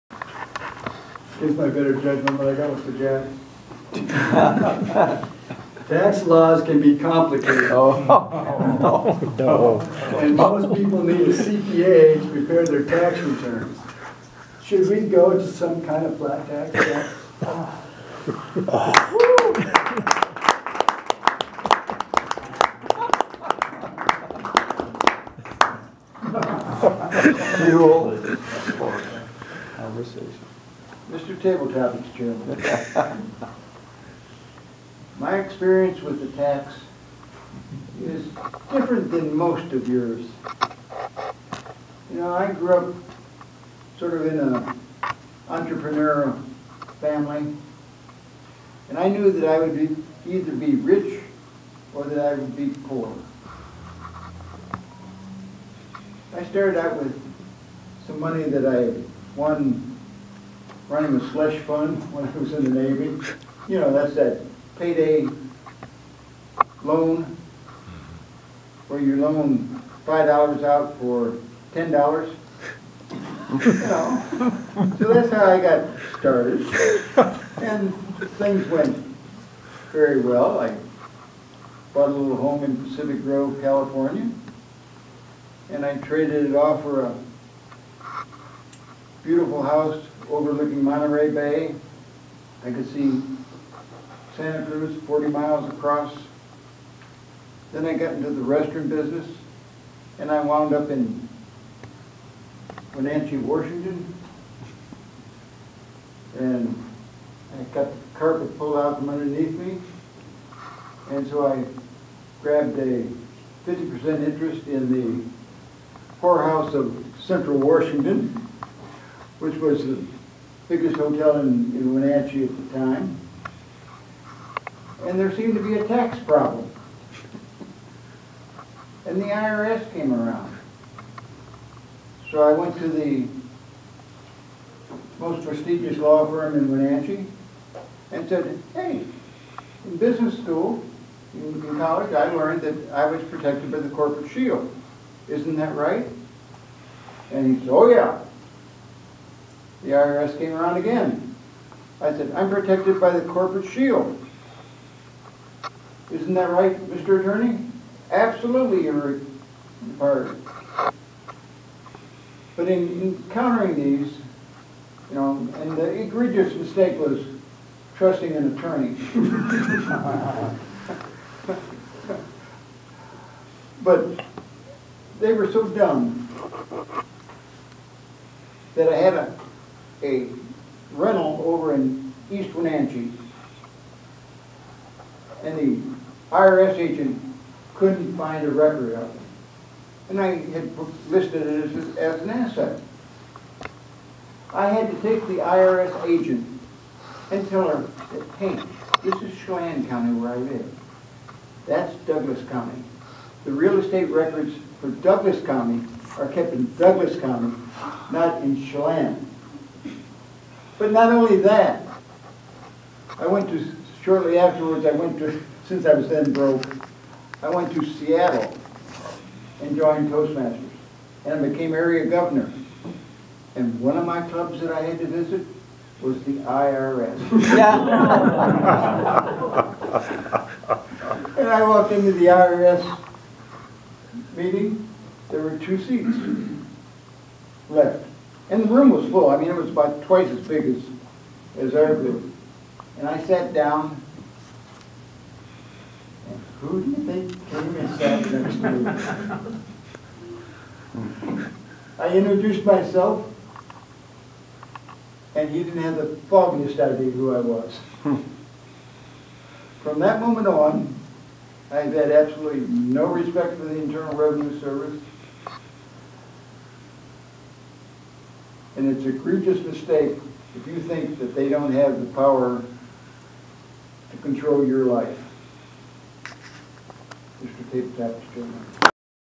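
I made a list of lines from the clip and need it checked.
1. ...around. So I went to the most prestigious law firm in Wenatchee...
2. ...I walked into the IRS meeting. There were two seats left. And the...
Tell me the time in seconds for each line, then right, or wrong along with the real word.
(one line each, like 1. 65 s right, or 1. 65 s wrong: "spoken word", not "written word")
1. 130 s right
2. 231 s right.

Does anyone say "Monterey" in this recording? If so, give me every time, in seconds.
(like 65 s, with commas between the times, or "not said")
90 s.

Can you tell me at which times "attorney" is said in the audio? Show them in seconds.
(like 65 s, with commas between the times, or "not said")
157 s, 168 s.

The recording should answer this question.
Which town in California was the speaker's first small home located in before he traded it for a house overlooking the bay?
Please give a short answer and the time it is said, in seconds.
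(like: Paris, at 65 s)
Pacific Grove, at 82 s.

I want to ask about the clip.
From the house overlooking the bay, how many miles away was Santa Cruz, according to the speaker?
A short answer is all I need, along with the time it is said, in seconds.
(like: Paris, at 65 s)
40, at 95 s.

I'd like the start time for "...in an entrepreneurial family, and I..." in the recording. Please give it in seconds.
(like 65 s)
44 s.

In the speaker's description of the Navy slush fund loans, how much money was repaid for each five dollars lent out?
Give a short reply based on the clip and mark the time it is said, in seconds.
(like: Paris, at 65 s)
$10, at 71 s.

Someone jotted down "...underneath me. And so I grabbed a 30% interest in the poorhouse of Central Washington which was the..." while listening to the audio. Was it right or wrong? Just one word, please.
wrong.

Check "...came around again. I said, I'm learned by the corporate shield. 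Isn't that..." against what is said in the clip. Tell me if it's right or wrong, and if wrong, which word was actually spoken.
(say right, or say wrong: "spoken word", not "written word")
wrong: "protected", not "learned".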